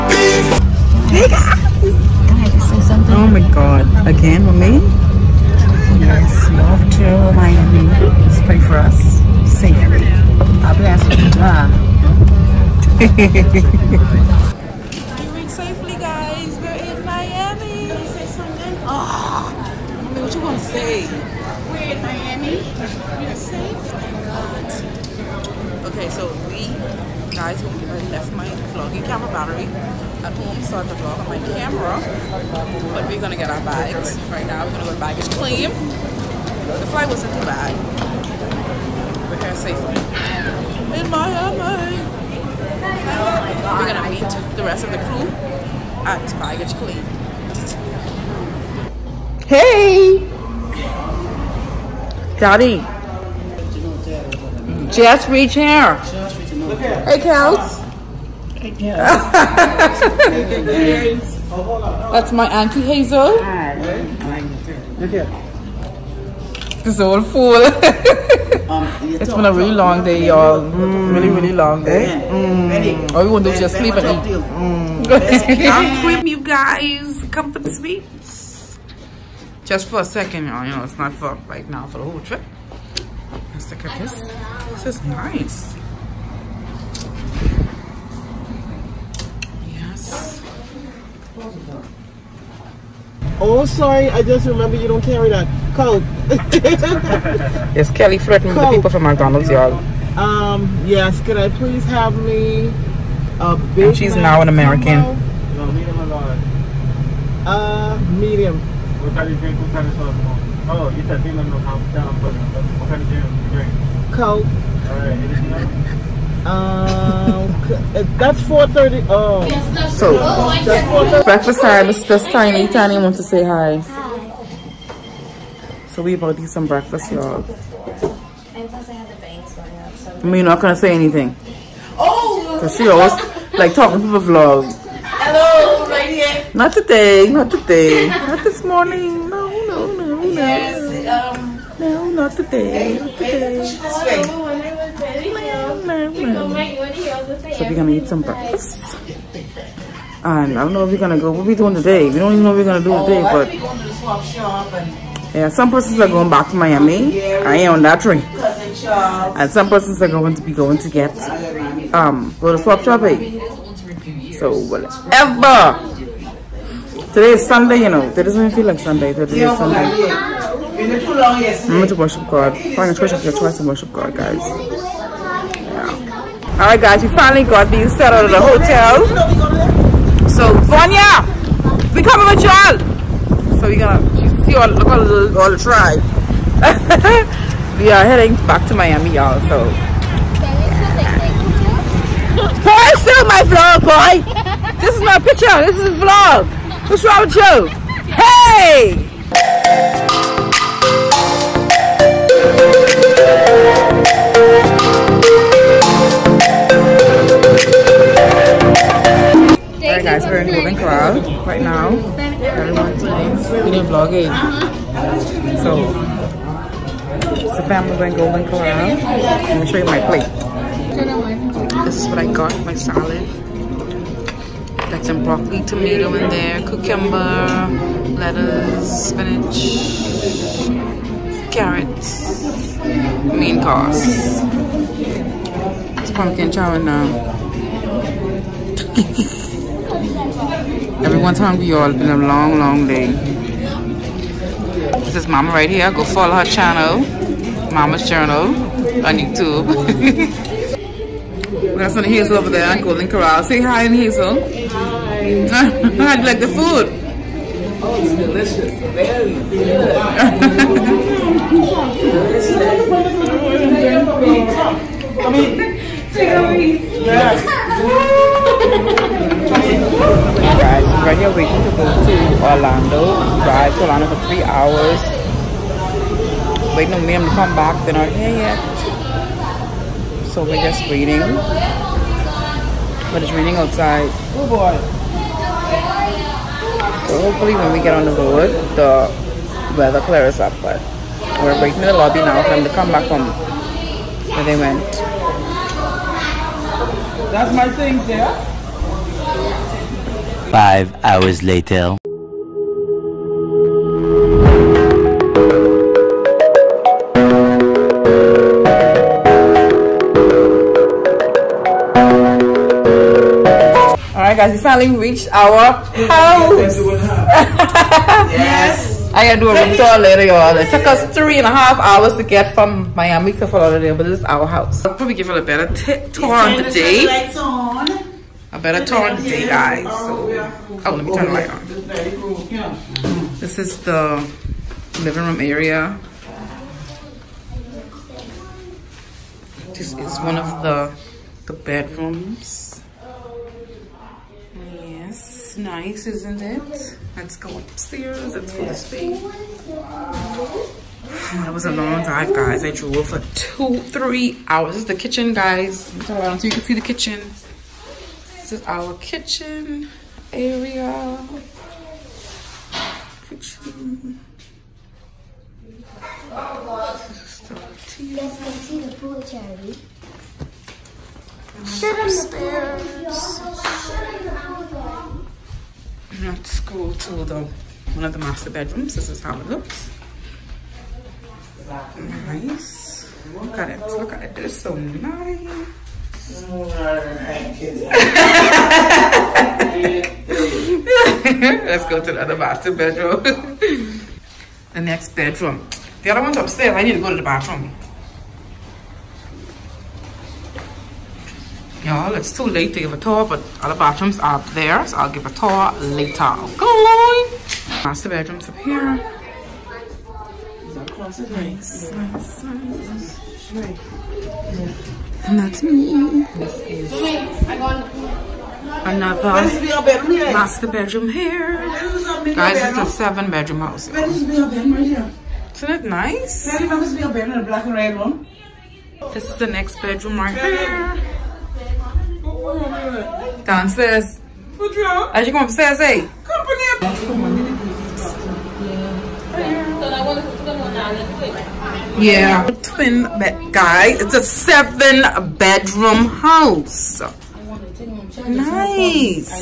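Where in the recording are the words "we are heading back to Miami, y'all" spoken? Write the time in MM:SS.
03:07.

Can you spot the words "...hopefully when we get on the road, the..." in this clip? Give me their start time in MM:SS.
04:47.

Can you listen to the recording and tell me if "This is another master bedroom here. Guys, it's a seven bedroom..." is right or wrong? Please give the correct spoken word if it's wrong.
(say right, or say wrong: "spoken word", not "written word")
right.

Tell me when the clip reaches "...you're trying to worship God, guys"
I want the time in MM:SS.
02:53.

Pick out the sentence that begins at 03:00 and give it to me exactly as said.
So Vanya, we coming with y'all.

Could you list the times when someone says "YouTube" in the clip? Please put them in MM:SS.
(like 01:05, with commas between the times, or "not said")
04:09.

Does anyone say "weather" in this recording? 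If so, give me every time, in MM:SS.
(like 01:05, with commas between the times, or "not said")
04:49.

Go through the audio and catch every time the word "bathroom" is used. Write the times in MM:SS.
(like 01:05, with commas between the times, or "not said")
06:37, 06:43.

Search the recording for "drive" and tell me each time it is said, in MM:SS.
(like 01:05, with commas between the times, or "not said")
04:33, 05:52.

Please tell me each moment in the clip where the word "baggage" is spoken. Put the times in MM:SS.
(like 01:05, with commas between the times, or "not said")
00:34, 00:46.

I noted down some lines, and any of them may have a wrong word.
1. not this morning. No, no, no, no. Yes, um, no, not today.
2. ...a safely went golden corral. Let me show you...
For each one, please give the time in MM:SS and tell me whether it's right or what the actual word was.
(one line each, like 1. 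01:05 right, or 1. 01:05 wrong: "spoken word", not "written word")
1. 02:18 right
2. 03:37 wrong: "family", not "safely".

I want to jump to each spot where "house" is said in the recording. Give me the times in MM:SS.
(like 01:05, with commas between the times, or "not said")
05:16, 05:24, 07:03, 07:26.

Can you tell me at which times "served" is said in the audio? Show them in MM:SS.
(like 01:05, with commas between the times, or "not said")
not said.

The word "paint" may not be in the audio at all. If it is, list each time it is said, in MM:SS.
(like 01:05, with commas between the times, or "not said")
not said.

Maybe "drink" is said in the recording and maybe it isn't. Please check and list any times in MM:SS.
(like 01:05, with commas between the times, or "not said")
01:49, 01:53.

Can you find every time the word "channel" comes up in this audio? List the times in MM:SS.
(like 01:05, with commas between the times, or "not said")
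04:06.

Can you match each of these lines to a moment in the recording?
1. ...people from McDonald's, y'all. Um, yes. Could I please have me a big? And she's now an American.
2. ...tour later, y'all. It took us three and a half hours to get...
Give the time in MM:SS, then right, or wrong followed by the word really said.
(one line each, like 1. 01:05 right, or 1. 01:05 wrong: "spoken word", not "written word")
1. 01:38 right
2. 05:19 right.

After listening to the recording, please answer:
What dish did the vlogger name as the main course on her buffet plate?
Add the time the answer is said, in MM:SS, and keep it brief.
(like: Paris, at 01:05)
pumpkin chow, at 03:56.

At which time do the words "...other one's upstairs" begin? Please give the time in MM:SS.
06:36.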